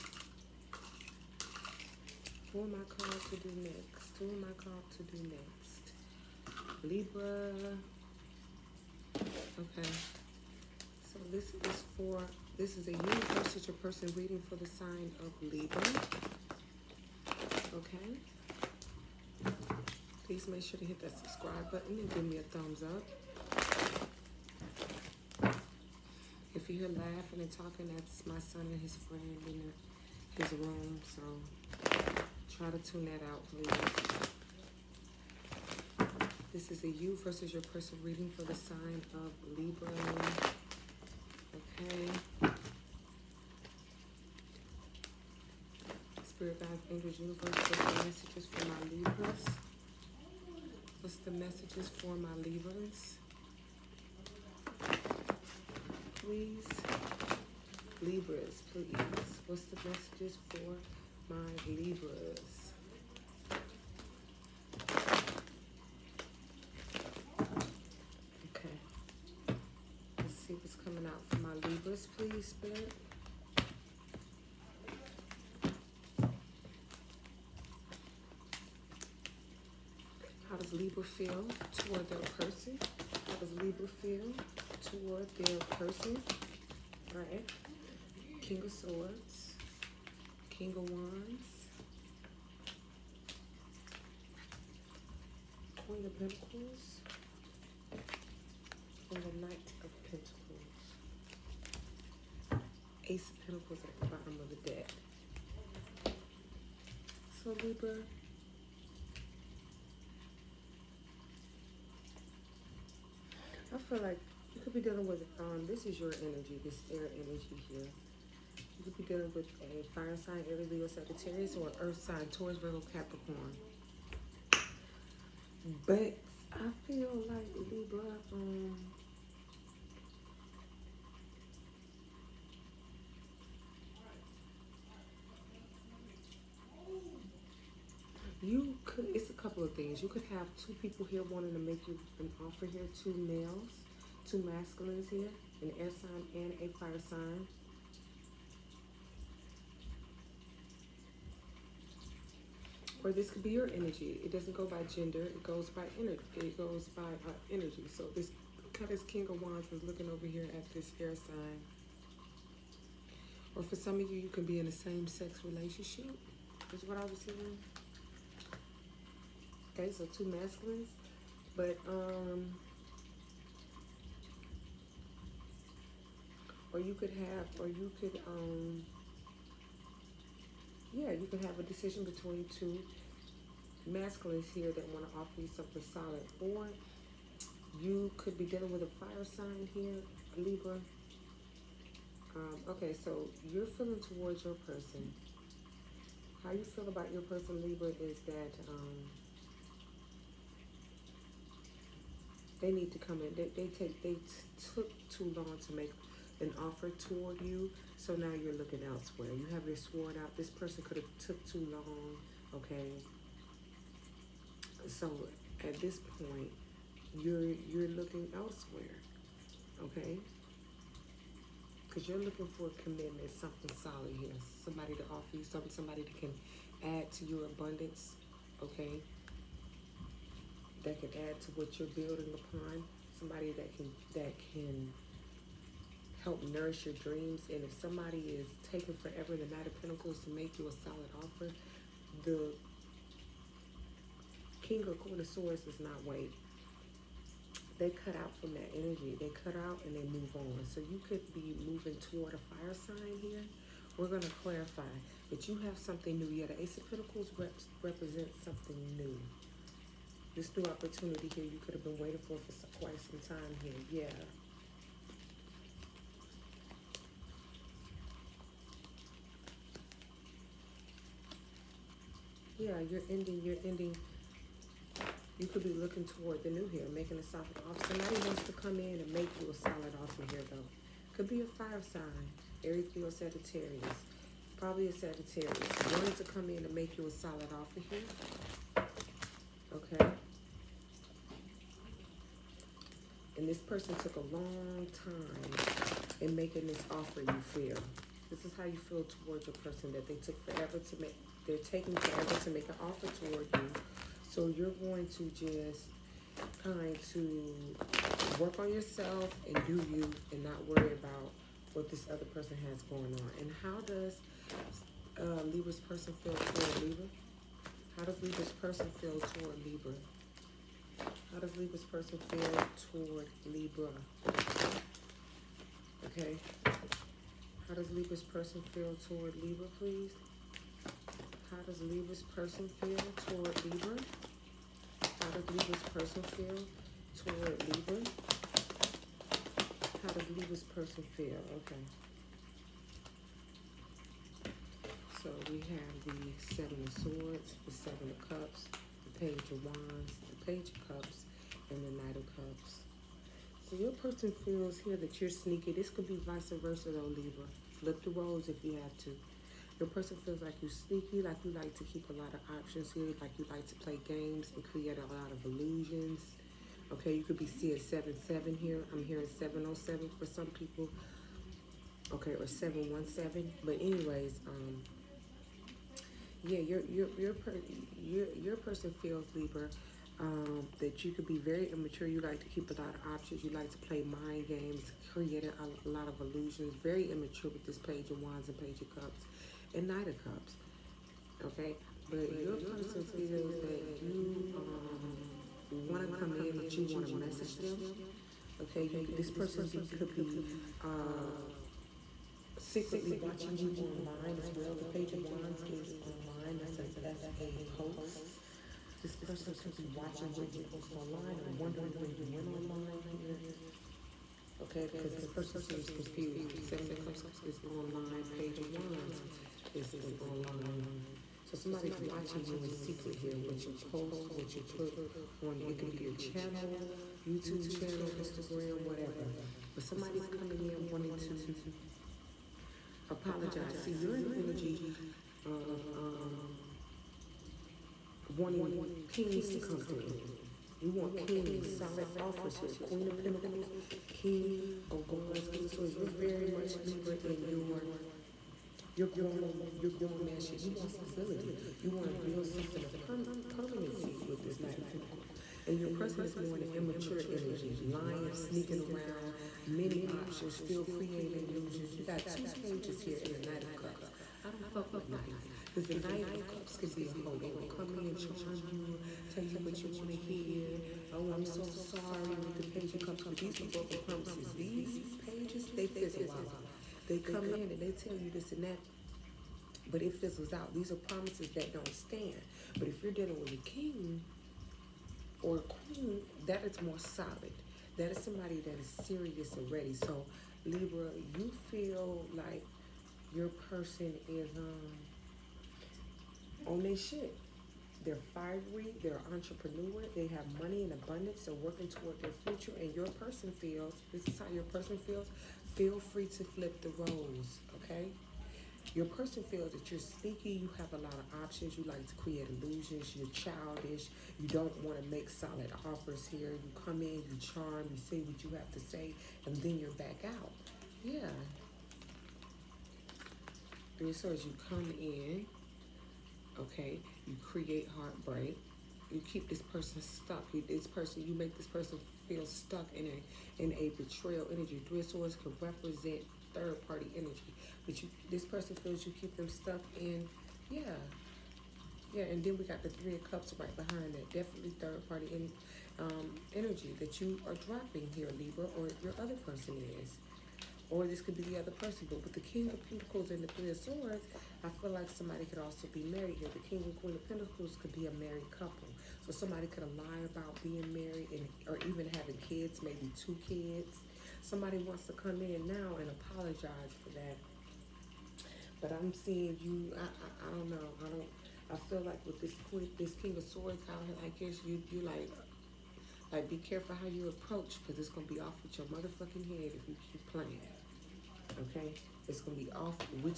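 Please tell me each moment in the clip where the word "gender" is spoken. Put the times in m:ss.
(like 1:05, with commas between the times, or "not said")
2:34.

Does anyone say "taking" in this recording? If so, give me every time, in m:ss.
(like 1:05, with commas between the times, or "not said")
3:58, 5:01.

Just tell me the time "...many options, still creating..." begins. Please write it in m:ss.
7:39.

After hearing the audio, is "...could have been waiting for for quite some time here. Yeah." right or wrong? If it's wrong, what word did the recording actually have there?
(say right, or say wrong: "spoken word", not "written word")
right.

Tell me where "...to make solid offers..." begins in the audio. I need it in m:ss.
8:35.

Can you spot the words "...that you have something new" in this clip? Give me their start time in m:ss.
4:15.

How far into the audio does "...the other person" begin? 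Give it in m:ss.
9:11.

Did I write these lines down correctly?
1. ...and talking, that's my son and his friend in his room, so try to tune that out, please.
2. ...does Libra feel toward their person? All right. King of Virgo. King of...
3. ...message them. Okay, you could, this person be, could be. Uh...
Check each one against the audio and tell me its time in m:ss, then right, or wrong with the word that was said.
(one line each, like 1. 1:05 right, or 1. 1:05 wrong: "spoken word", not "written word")
1. 0:27 right
2. 1:23 wrong: "Swords", not "Virgo"
3. 6:37 right.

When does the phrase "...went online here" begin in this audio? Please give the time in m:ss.
6:52.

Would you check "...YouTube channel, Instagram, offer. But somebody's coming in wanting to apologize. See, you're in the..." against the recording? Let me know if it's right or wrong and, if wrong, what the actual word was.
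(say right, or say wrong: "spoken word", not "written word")
wrong: "whatever", not "offer".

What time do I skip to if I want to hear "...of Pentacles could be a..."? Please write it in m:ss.
9:17.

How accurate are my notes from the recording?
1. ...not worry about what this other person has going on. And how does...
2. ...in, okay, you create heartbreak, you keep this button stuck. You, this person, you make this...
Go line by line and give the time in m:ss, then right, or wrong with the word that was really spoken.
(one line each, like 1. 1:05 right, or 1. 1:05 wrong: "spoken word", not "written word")
1. 5:10 right
2. 8:44 wrong: "person", not "button".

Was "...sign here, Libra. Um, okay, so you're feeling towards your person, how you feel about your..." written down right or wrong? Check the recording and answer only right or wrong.
right.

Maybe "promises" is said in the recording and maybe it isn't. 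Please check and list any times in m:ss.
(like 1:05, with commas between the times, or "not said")
7:54, 8:00.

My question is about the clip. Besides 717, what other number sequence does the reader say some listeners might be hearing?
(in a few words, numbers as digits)
707.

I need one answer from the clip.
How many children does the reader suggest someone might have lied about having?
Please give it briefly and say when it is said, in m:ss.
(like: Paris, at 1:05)
2, at 9:23.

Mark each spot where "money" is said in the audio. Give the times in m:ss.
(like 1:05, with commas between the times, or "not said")
8:20.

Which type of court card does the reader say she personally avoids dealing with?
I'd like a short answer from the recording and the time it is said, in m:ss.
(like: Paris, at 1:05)
Knights, at 7:44.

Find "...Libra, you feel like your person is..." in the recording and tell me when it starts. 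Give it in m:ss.
8:10.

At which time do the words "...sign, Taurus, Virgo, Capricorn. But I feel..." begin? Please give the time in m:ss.
2:02.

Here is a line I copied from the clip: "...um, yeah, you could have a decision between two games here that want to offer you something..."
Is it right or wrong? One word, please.
wrong.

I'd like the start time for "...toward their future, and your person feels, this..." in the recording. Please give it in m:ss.
8:21.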